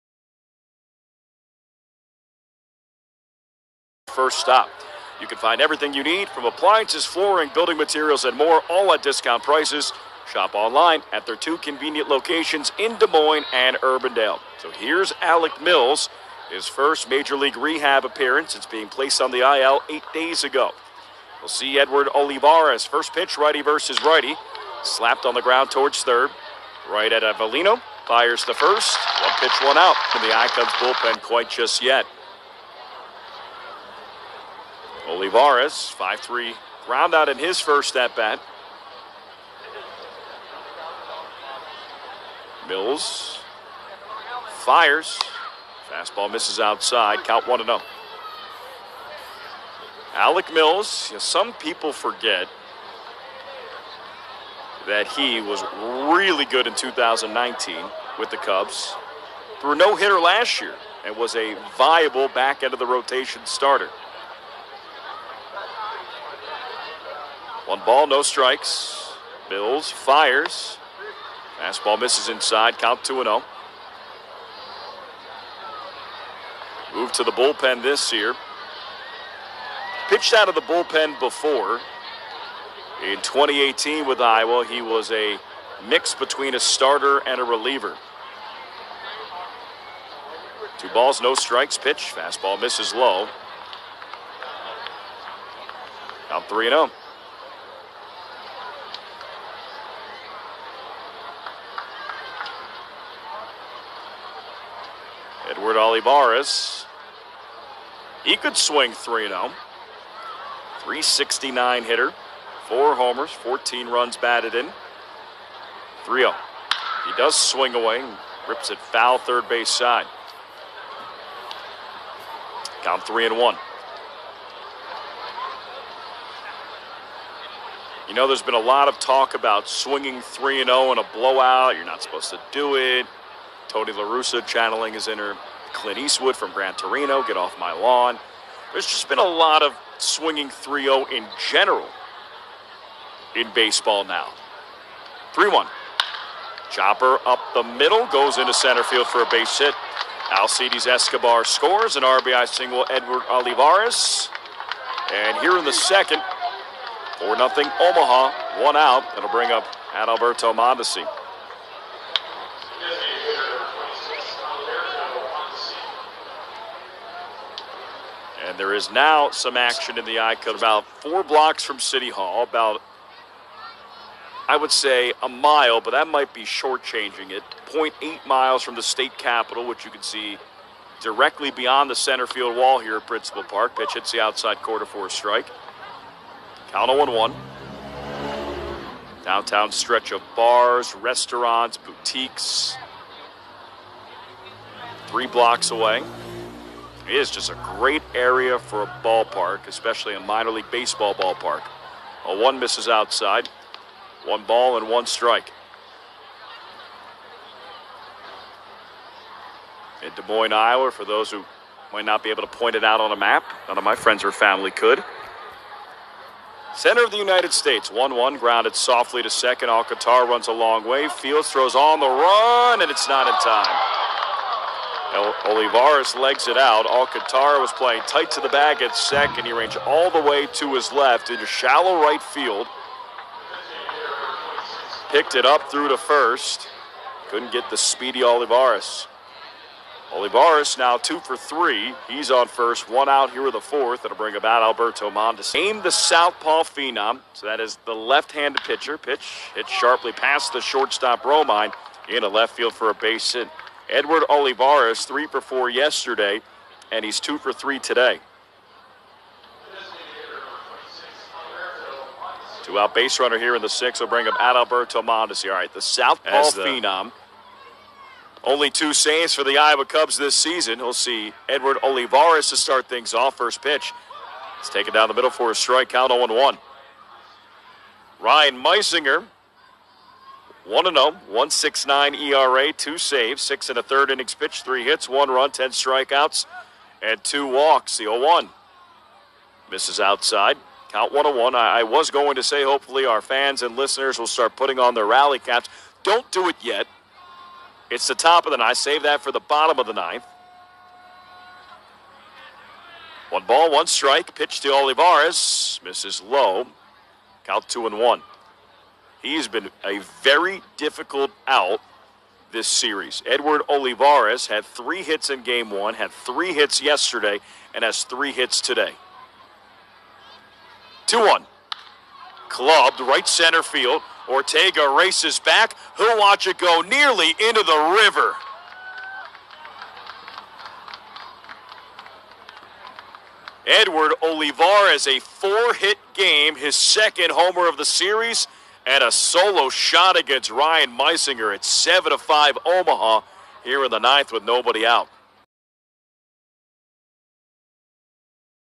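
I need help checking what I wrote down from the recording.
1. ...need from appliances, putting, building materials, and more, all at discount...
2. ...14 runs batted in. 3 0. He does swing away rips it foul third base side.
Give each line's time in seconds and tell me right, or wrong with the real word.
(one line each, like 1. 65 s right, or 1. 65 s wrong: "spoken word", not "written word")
1. 6 s wrong: "flooring", not "putting"
2. 113 s right.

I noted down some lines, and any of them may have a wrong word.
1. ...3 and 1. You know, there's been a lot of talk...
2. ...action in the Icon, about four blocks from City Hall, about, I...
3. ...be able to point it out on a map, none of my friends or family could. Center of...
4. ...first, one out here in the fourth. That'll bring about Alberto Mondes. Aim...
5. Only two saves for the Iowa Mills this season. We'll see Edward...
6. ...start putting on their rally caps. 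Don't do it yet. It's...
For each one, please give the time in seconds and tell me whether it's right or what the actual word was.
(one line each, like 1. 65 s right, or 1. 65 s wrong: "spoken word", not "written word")
1. 123 s right
2. 169 s right
3. 212 s right
4. 242 s right
5. 268 s wrong: "Cubs", not "Mills"
6. 294 s right.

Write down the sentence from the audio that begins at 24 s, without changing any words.
Slapped on the ground towards third.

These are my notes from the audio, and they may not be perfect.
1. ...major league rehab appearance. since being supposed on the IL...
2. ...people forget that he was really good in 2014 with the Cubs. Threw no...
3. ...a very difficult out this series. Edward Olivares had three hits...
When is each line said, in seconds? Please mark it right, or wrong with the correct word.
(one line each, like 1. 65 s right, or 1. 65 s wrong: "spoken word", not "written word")
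1. 17 s wrong: "placed", not "supposed"
2. 51 s wrong: "2019", not "2014"
3. 309 s right.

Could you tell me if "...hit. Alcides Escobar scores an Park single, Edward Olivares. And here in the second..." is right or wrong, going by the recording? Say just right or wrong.
wrong.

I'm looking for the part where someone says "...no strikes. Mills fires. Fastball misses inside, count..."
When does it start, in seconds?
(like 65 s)
68 s.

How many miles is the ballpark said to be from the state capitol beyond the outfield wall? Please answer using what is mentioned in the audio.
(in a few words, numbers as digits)
0.8 miles.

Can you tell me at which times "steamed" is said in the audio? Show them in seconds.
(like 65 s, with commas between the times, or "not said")
not said.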